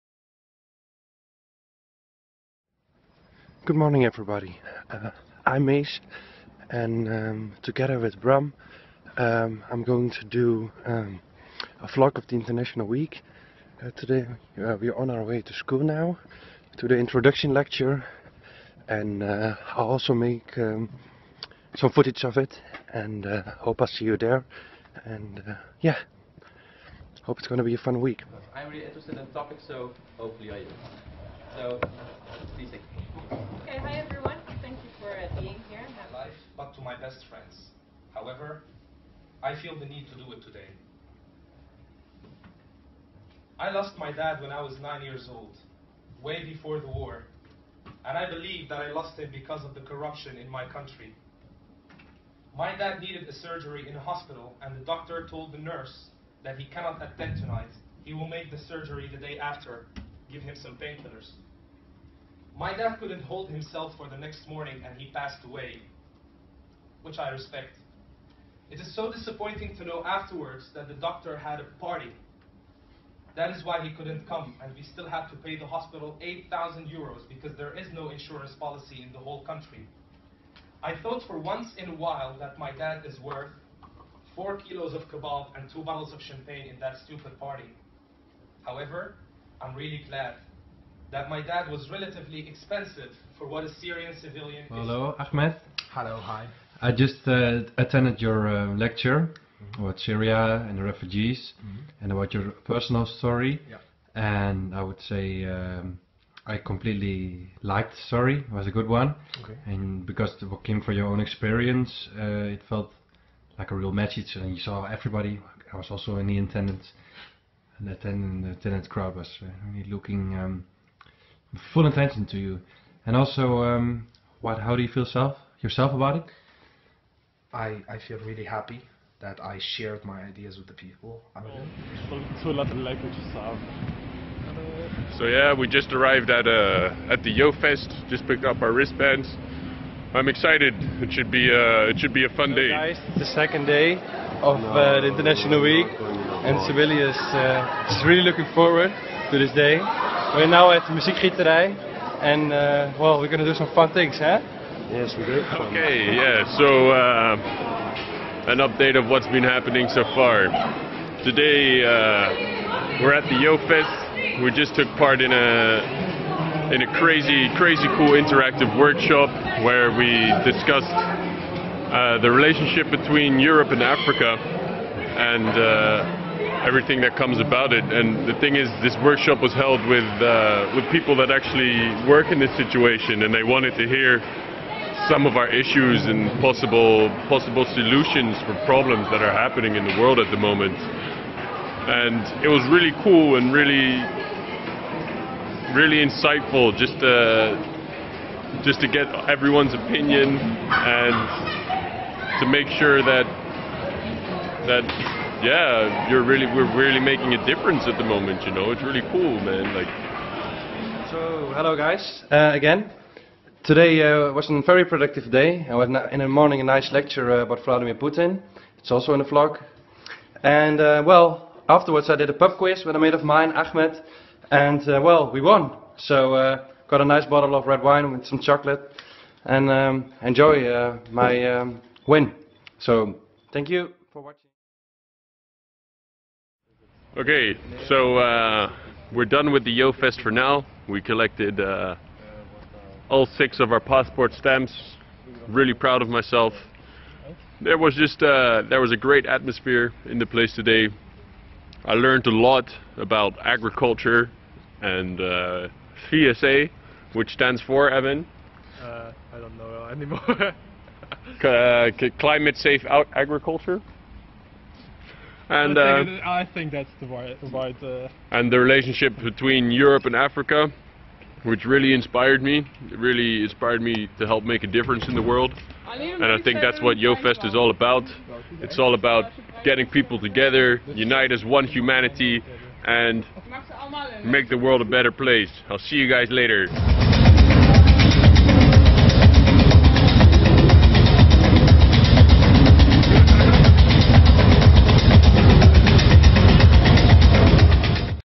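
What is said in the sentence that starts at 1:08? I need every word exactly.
It is so disappointing to know afterwards that the doctor had a party.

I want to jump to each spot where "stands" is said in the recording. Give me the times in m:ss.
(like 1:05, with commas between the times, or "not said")
4:17.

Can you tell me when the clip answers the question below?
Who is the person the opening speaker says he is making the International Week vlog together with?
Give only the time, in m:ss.
0:08.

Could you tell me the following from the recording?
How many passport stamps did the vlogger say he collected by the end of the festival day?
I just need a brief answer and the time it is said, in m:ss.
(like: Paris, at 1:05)
6, at 4:03.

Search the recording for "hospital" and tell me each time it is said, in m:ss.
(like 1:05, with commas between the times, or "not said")
0:53, 1:15.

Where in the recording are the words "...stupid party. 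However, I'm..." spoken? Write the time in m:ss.
1:27.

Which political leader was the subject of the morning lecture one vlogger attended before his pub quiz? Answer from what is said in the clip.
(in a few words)
Vladimir Putin.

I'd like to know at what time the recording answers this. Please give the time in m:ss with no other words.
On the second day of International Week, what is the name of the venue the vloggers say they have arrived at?
2:30.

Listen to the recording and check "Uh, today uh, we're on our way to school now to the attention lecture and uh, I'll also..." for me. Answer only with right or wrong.
wrong.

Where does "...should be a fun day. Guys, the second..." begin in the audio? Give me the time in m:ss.
2:21.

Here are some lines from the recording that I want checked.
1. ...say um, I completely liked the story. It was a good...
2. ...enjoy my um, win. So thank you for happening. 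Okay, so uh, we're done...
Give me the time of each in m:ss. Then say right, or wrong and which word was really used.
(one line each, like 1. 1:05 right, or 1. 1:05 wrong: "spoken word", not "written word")
1. 1:45 right
2. 3:50 wrong: "watching", not "happening".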